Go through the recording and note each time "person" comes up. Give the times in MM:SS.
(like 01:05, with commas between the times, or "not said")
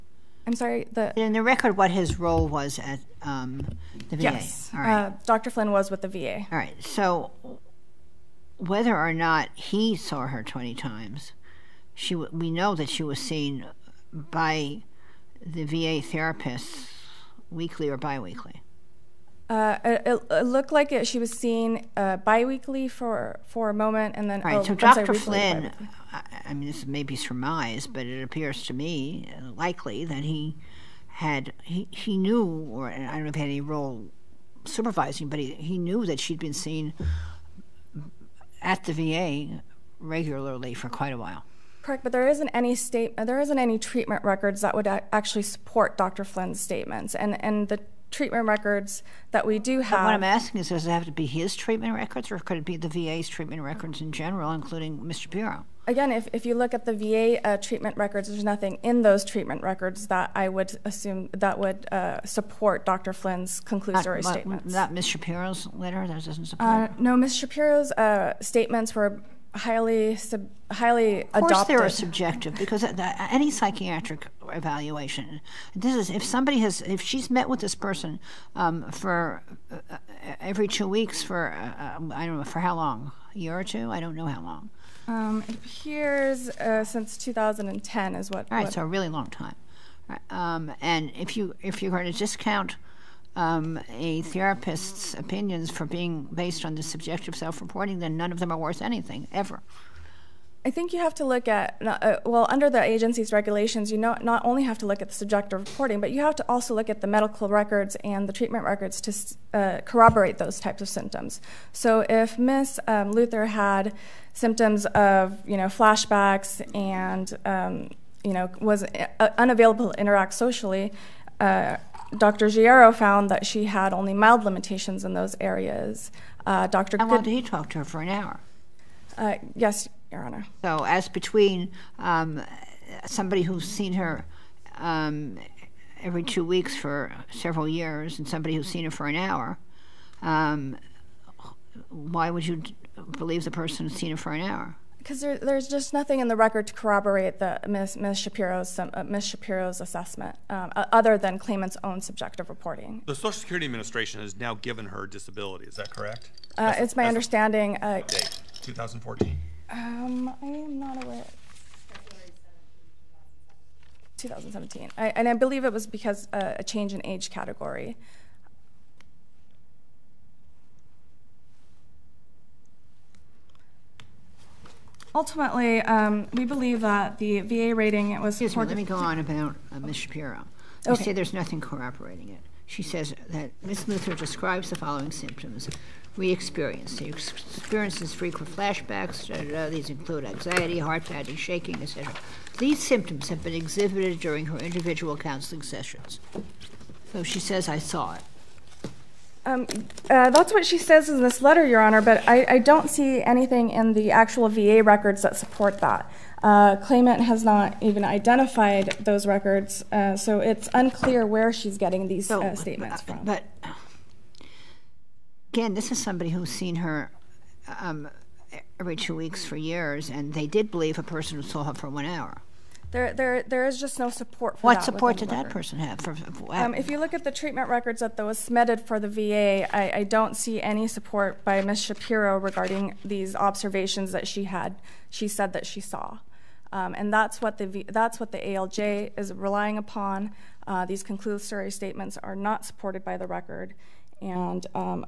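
01:17, 02:23, 03:41, 03:45.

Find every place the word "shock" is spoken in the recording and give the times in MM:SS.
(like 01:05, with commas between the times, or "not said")
not said.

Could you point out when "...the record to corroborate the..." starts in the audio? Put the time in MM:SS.
02:26.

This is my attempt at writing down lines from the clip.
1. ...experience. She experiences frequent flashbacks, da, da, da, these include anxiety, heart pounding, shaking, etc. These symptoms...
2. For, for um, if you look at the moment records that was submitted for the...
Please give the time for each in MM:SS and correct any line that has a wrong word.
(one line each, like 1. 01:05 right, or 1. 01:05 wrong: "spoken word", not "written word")
1. 03:06 right
2. 03:45 wrong: "treatment", not "moment".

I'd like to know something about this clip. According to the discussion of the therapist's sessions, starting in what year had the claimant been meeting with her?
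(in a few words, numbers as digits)
2010.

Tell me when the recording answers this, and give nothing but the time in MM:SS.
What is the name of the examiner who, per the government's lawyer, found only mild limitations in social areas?
02:02.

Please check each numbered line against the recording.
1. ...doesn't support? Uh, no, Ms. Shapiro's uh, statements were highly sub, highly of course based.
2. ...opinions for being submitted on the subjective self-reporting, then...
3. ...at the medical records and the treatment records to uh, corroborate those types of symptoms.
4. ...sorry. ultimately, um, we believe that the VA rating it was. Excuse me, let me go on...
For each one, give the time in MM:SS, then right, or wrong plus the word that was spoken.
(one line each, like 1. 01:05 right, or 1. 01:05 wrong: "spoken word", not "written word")
1. 01:06 wrong: "adopted", not "based"
2. 01:35 wrong: "based", not "submitted"
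3. 01:46 right
4. 02:47 wrong: "category", not "sorry".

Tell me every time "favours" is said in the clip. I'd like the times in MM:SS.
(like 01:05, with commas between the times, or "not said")
not said.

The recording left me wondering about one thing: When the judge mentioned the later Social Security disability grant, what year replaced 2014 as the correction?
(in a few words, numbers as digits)
2017.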